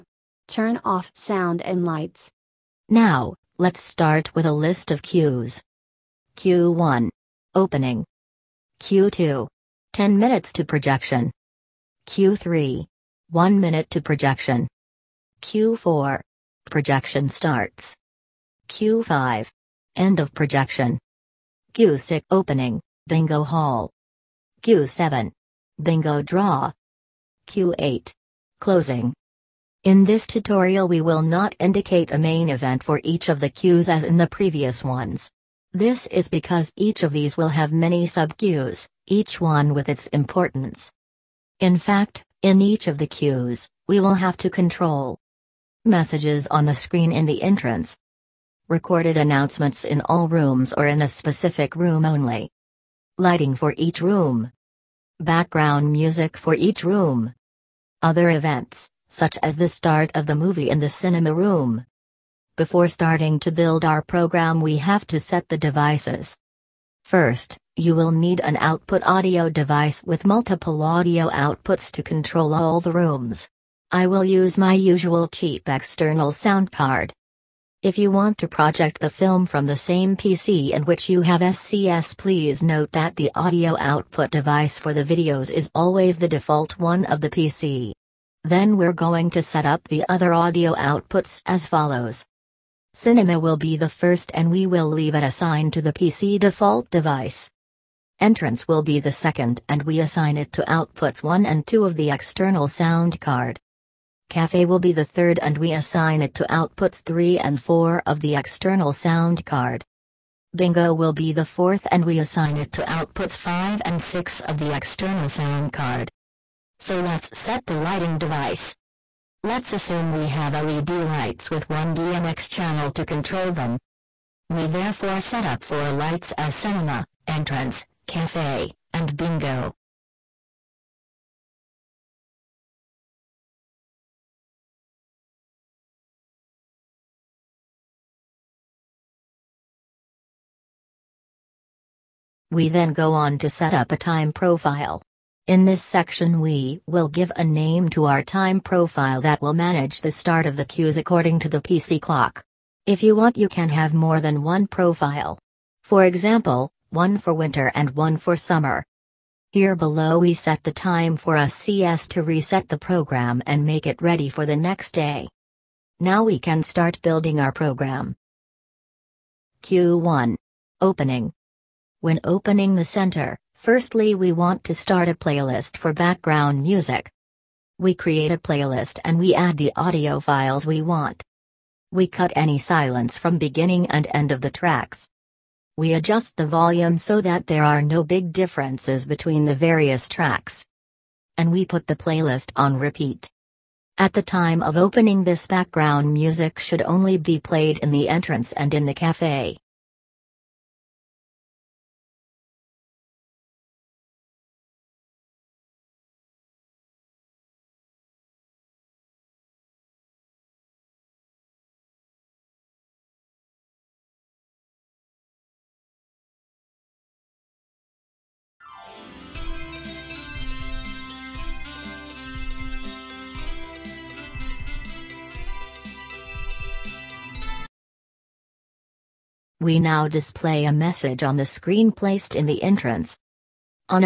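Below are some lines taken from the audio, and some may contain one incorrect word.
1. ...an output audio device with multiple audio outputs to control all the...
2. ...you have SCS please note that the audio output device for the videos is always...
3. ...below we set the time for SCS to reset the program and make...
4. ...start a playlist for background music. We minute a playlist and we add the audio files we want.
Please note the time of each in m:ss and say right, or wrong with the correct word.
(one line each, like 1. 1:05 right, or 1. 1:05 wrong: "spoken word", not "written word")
1. 1:08 right
2. 1:21 right
3. 2:39 right
4. 2:54 wrong: "create", not "minute".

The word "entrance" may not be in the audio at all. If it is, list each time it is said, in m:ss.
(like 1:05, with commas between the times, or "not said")
0:47, 1:38, 2:07, 3:18, 3:52.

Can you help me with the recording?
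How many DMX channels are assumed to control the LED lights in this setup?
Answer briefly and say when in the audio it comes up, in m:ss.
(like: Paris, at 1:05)
1, at 2:01.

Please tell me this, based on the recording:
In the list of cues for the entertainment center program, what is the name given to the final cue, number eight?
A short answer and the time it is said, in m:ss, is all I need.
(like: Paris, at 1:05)
Closing, at 0:27.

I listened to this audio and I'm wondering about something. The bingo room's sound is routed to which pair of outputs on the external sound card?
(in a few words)
5 and 6.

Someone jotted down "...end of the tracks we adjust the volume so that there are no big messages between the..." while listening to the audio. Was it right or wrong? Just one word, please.
wrong.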